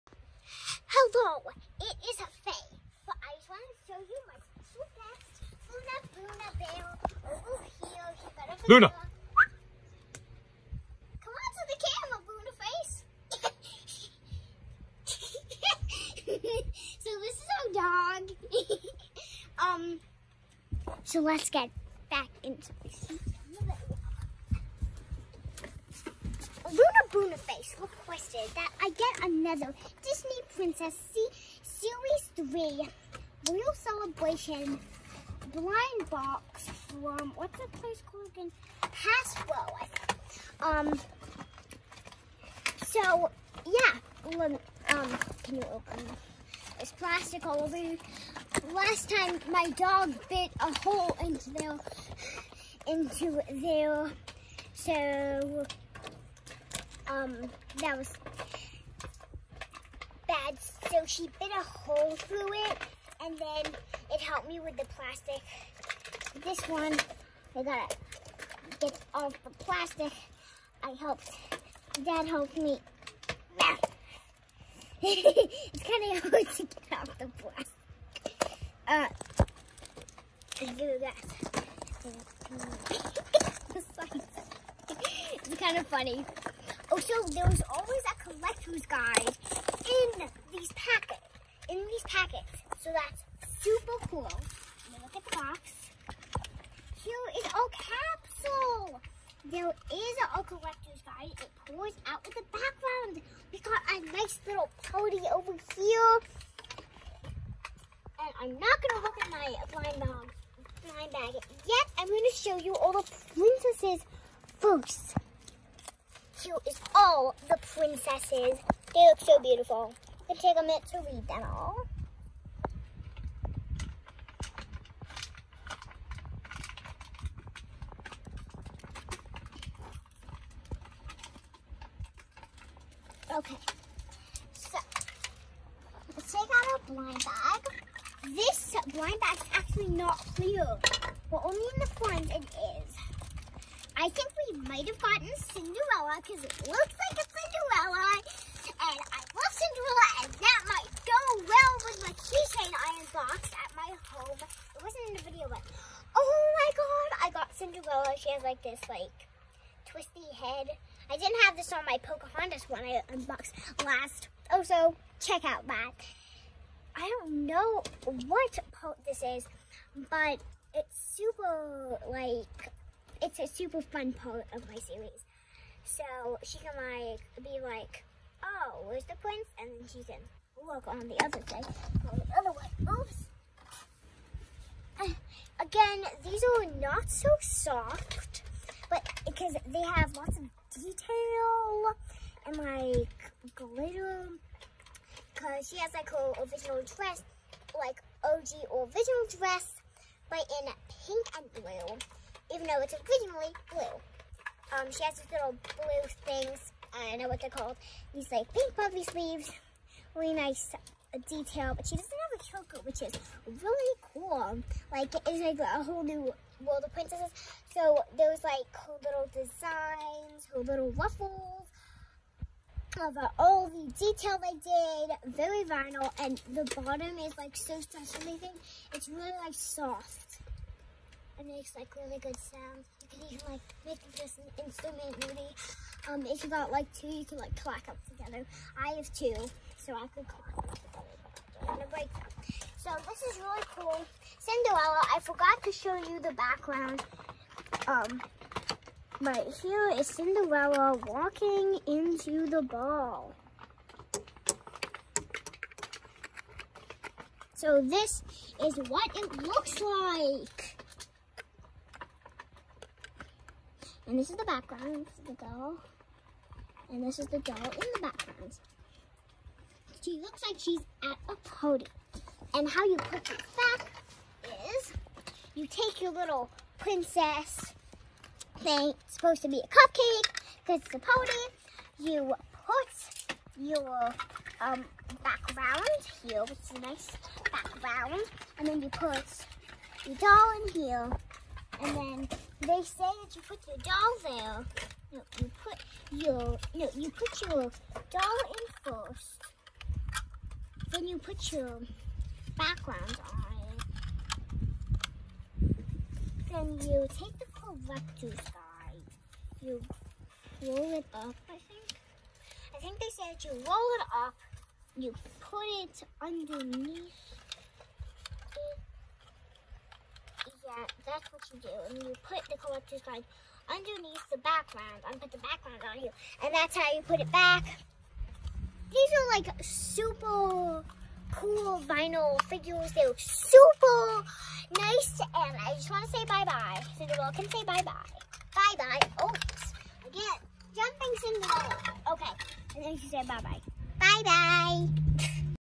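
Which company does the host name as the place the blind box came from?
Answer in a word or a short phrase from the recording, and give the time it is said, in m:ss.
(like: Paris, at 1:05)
Hasbro, at 0:39.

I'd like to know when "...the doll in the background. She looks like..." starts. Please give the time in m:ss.
4:27.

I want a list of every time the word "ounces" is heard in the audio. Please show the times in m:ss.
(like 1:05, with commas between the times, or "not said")
not said.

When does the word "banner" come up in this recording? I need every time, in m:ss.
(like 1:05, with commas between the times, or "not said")
not said.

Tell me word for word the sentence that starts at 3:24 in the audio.
Um, she has these little blue things.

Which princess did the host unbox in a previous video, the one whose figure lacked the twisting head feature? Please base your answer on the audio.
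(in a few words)
Pocahontas.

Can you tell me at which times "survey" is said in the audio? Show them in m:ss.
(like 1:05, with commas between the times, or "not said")
not said.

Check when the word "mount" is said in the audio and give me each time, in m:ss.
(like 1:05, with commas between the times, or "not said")
not said.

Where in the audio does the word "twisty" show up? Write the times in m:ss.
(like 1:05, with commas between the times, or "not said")
2:39.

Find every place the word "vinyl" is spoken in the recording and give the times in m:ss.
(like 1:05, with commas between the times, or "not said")
3:45, 5:31.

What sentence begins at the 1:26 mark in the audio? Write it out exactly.
Also, oh, there was always a collector's guide in these packets.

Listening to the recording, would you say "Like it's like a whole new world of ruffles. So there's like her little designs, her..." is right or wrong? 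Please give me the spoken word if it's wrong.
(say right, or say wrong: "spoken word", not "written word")
wrong: "princesses", not "ruffles".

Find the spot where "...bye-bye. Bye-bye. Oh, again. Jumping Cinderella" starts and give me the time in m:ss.
5:37.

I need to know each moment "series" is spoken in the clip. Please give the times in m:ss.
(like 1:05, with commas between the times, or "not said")
0:31, 2:54.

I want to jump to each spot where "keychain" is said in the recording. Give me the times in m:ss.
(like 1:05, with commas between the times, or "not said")
2:32.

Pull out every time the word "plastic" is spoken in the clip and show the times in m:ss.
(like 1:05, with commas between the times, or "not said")
0:46, 1:04, 1:09, 1:17.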